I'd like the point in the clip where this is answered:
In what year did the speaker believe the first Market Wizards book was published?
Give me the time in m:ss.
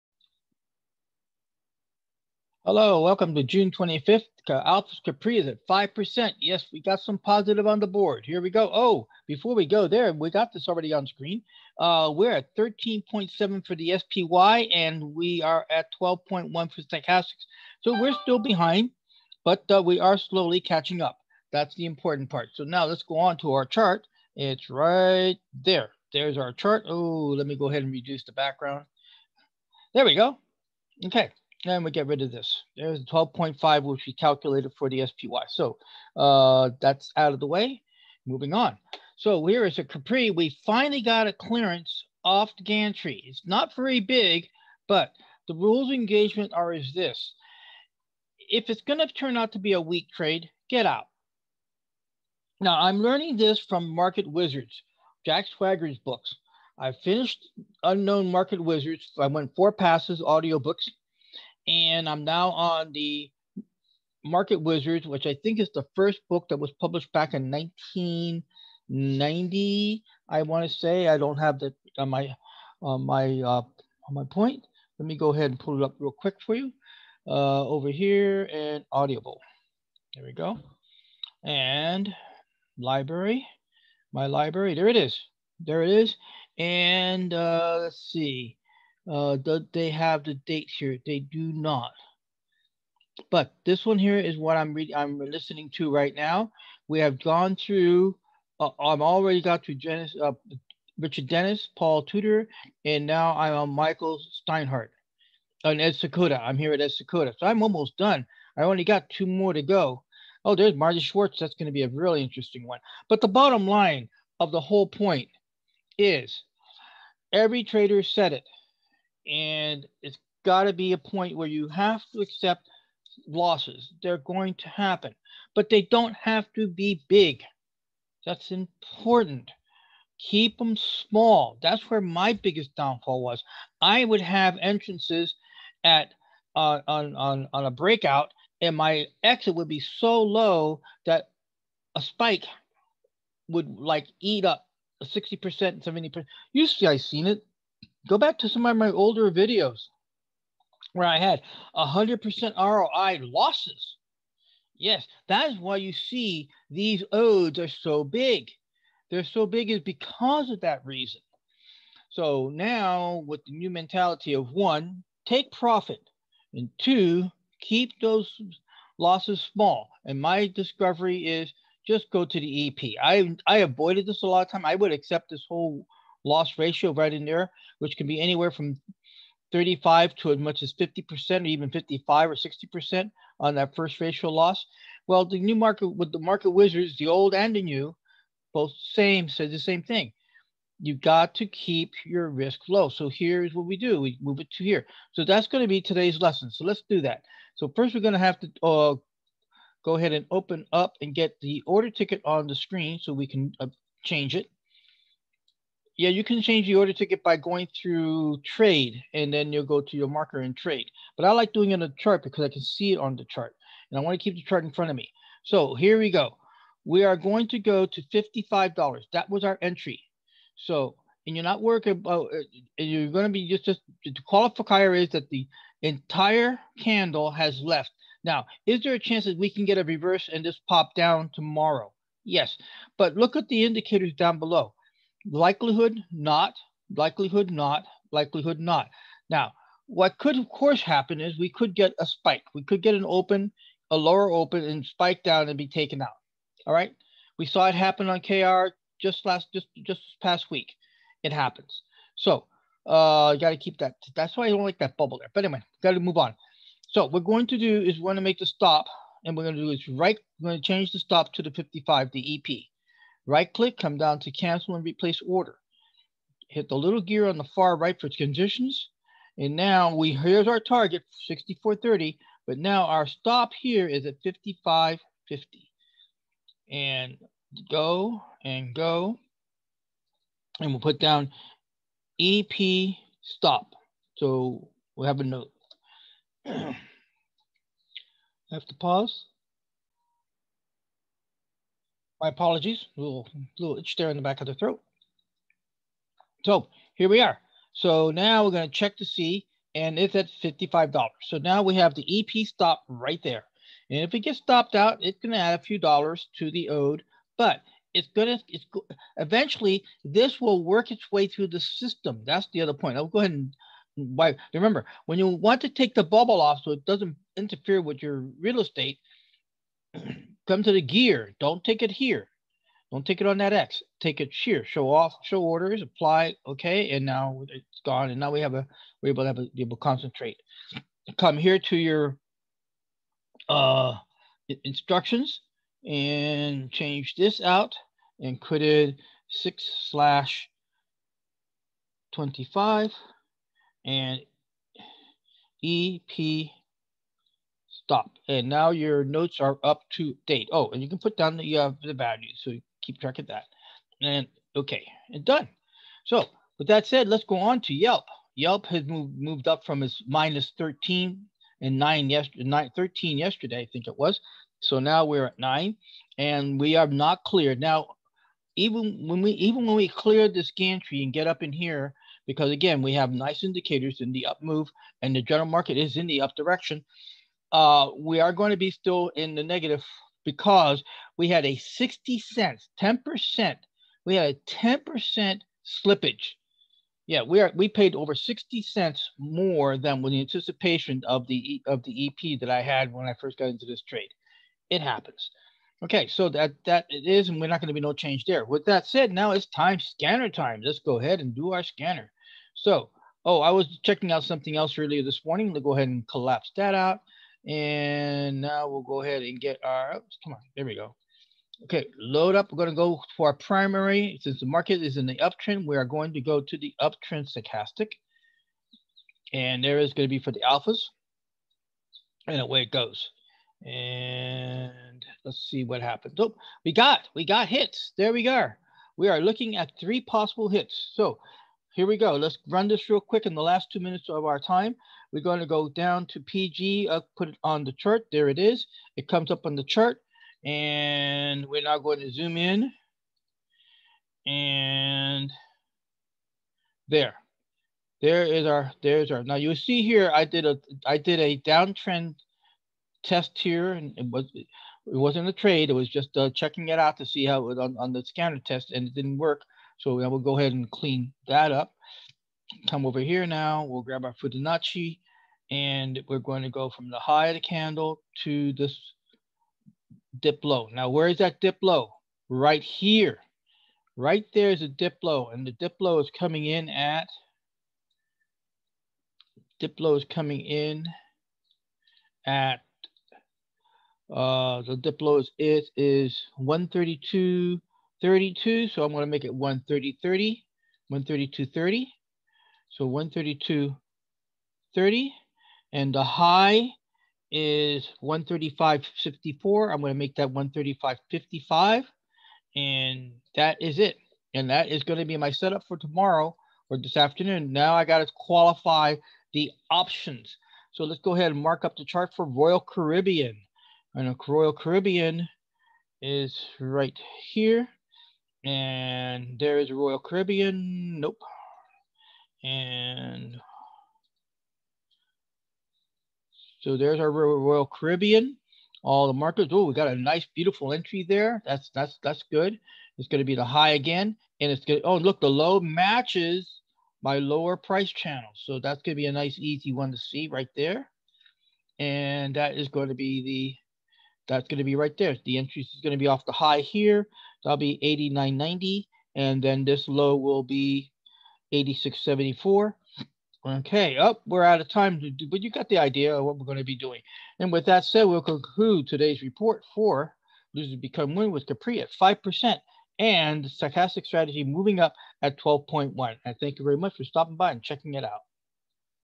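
1:07.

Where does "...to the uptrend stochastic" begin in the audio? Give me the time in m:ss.
6:56.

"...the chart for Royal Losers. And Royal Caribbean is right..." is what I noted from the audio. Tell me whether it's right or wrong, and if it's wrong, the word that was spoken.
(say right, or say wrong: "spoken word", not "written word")
wrong: "Caribbean", not "Losers".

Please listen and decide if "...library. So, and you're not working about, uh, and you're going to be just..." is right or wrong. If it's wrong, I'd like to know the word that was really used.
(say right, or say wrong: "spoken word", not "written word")
wrong: "entry", not "library".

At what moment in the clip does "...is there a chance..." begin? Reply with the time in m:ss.
3:48.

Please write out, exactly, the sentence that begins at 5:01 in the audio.
So now we have the EP stop right there.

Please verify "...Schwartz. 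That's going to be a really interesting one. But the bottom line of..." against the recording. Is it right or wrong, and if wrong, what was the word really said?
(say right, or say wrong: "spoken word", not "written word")
right.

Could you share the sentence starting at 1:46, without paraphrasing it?
I'm here at Ed Seykota, so I'm almost done.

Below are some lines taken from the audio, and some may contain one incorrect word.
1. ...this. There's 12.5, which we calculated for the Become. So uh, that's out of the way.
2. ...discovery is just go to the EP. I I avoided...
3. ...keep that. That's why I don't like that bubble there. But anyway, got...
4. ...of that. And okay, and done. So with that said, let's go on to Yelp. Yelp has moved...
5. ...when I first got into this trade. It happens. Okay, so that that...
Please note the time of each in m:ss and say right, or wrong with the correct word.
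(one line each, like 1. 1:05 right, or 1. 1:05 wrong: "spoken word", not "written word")
1. 0:32 wrong: "SPY", not "Become"
2. 2:50 right
3. 4:13 right
4. 5:53 right
5. 6:32 right.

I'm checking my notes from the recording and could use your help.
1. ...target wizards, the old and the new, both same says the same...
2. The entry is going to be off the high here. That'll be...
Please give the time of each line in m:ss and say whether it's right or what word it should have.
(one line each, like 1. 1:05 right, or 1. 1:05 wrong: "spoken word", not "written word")
1. 3:06 wrong: "market", not "target"
2. 9:05 right.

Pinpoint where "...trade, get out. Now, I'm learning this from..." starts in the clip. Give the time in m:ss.
0:50.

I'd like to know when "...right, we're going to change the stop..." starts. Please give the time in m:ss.
4:19.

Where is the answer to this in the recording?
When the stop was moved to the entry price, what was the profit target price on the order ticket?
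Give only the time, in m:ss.
4:31.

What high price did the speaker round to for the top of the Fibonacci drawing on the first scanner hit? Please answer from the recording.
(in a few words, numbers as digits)
135.55.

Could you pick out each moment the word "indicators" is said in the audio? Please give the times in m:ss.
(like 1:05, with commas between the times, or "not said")
3:53, 6:13.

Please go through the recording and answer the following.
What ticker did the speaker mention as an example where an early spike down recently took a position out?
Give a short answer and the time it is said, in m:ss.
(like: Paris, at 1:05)
KR, at 4:08.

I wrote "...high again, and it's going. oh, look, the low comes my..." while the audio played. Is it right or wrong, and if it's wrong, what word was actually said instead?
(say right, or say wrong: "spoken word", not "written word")
wrong: "matches", not "comes".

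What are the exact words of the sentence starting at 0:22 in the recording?
So now let's go on to our chart.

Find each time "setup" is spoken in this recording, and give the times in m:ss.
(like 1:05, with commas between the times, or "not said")
8:25.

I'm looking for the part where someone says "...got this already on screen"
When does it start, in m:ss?
0:10.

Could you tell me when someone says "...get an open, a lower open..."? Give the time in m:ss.
4:02.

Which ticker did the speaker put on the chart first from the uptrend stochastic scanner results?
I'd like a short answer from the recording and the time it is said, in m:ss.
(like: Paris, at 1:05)
PG, at 7:16.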